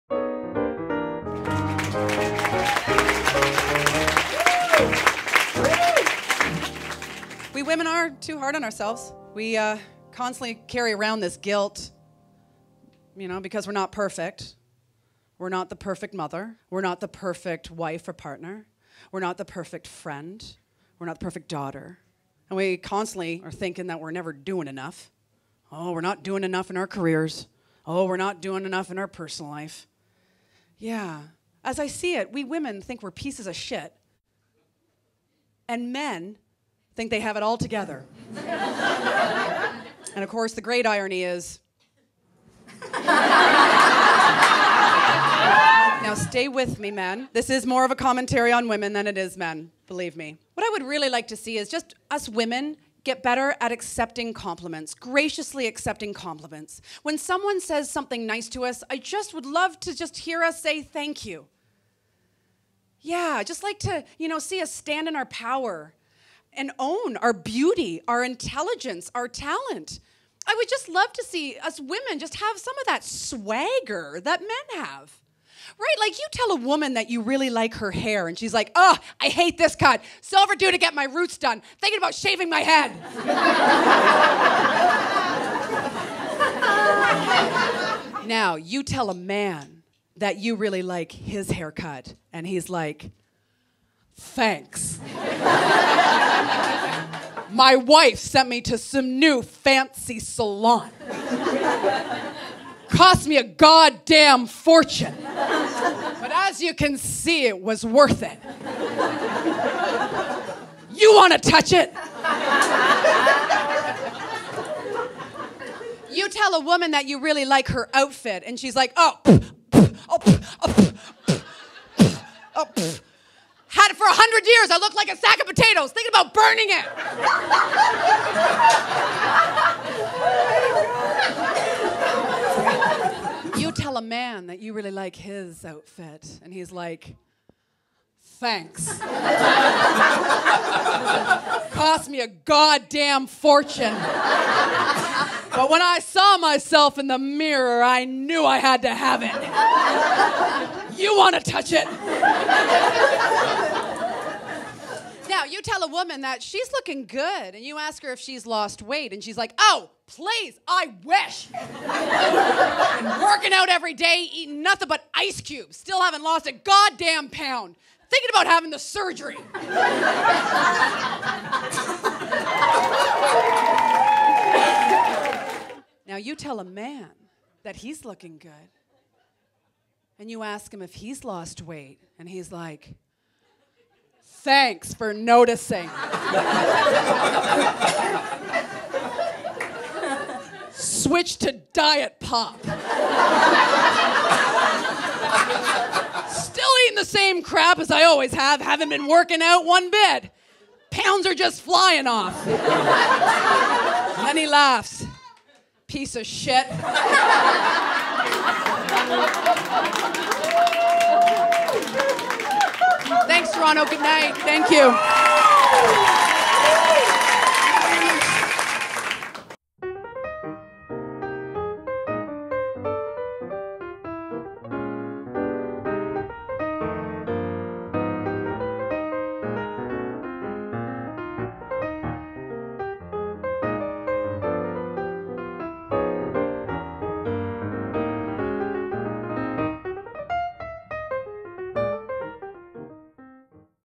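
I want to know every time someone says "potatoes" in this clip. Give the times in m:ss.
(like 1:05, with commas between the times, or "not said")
2:05.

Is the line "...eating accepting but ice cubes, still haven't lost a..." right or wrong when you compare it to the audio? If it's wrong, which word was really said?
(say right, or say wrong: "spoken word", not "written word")
wrong: "nothing", not "accepting".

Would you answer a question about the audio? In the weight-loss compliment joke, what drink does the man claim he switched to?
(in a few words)
diet pop.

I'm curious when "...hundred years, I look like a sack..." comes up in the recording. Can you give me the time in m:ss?
2:04.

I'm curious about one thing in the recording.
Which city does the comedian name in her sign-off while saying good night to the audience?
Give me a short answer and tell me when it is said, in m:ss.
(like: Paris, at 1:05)
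Toronto, at 3:33.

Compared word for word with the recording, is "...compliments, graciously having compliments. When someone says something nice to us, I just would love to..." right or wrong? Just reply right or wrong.
wrong.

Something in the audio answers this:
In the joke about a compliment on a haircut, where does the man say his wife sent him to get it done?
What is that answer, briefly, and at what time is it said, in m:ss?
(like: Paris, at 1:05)
new fancy salon, at 1:39.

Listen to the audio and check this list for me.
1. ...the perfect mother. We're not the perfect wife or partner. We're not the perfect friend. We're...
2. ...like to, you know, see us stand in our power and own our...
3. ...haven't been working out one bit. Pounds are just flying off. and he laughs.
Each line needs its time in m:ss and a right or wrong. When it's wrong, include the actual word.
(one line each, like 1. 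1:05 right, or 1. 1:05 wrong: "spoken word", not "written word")
1. 0:15 right
2. 1:03 right
3. 3:18 right.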